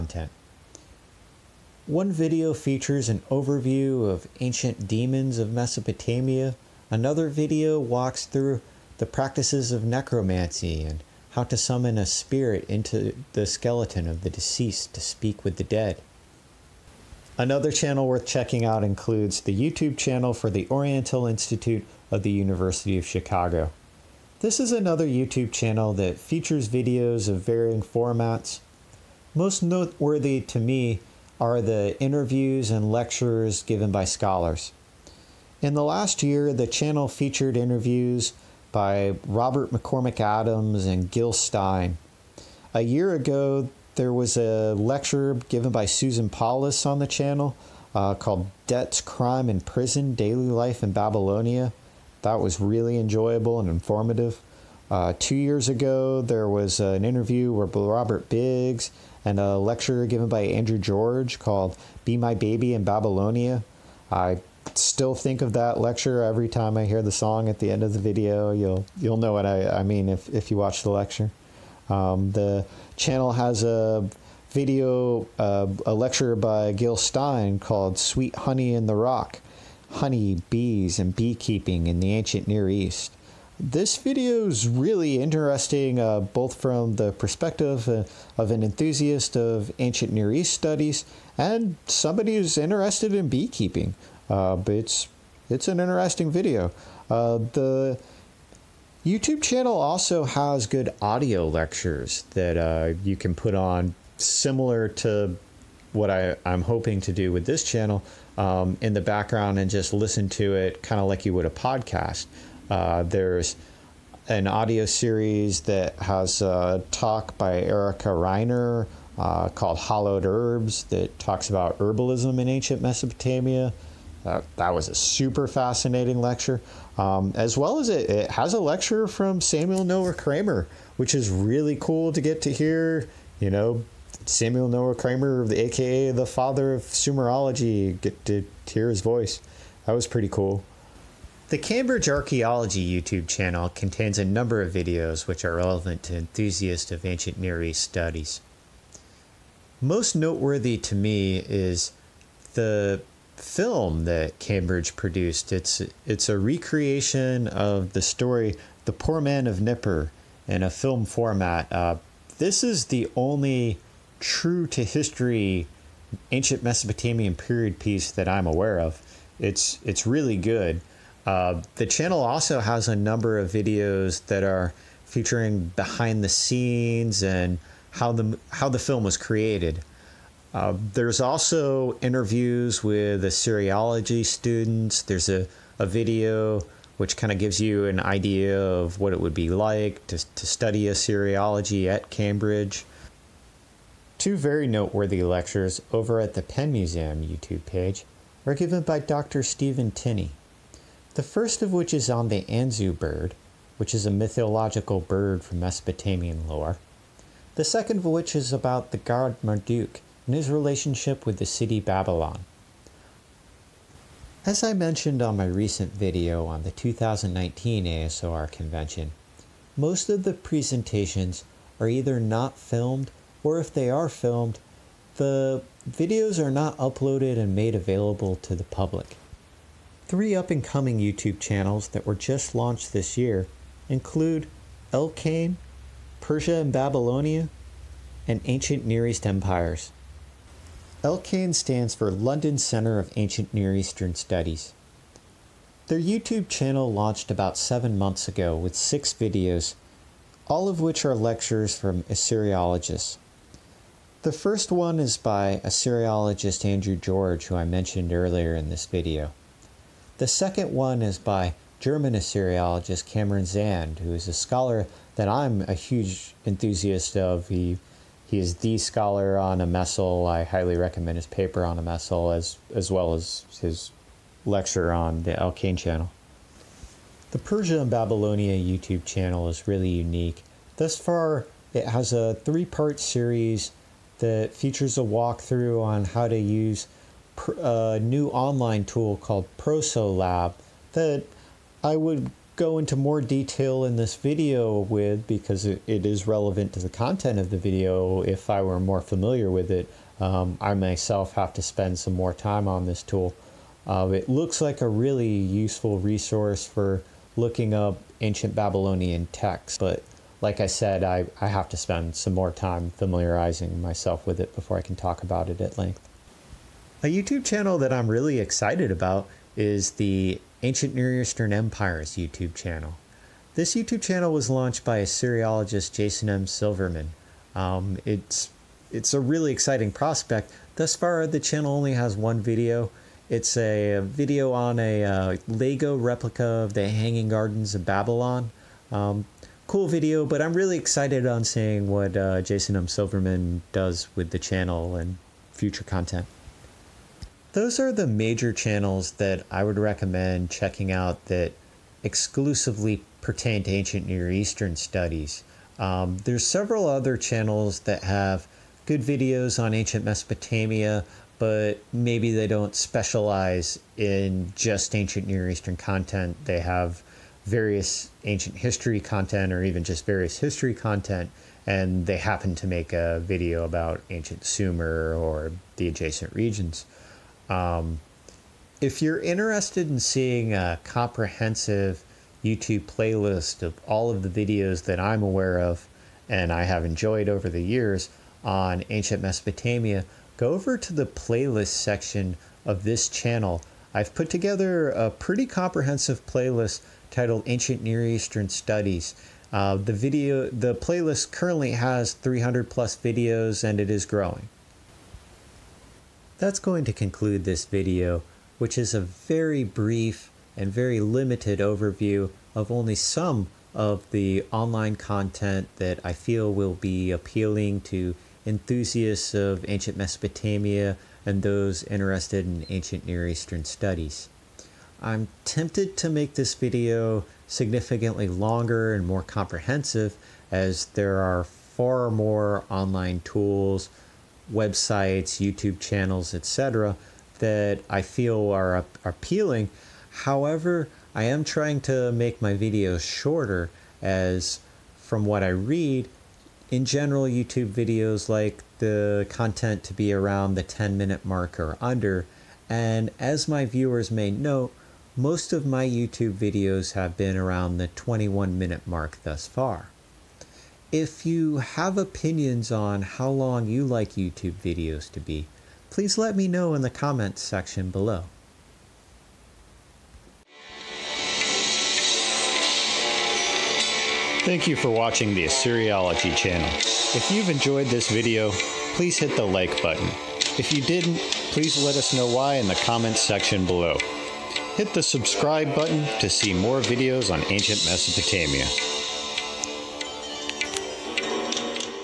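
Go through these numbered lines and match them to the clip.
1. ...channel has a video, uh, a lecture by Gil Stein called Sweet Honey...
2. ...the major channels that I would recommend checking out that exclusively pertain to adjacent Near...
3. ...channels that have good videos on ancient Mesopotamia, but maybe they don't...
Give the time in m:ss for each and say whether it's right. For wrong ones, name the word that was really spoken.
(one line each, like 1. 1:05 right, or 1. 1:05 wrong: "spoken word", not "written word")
1. 1:12 right
2. 5:47 wrong: "ancient", not "adjacent"
3. 5:57 right.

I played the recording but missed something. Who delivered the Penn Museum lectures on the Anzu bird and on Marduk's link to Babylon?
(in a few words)
Stephen Tinney.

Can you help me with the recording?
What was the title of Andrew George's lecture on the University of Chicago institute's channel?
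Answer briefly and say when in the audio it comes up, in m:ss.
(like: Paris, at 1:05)
Be My Baby in Babylonia, at 1:02.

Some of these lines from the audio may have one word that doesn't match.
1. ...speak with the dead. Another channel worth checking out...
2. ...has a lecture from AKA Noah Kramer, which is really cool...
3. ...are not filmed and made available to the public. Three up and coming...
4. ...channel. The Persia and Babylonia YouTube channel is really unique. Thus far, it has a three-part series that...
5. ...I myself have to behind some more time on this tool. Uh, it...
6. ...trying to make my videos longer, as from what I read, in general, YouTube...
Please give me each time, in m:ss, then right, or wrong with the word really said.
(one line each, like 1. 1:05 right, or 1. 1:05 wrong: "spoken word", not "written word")
1. 0:15 right
2. 2:08 wrong: "Samuel", not "AKA"
3. 3:46 wrong: "uploaded", not "filmed"
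4. 4:35 right
5. 5:00 wrong: "spend", not "behind"
6. 7:21 wrong: "shorter", not "longer".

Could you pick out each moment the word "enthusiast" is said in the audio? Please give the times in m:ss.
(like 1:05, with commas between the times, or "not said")
1:28, 2:26, 4:26, 6:58.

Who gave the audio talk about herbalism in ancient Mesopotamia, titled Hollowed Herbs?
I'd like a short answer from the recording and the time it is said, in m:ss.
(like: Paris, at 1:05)
Erica Reiner, at 1:57.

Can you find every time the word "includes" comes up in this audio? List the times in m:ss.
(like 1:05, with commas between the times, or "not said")
0:18, 3:53.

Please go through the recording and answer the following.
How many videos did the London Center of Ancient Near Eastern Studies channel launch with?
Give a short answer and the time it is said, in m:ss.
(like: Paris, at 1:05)
6, at 4:08.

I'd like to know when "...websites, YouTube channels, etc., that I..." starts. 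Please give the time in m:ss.
7:14.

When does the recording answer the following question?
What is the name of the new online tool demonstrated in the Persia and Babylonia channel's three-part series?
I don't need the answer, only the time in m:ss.
4:49.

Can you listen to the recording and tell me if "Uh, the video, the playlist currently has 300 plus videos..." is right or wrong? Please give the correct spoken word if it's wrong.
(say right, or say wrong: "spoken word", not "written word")
right.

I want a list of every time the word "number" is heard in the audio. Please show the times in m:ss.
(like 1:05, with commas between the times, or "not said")
2:24, 2:52.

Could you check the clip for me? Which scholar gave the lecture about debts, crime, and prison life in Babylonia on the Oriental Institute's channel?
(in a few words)
Susan Paulus.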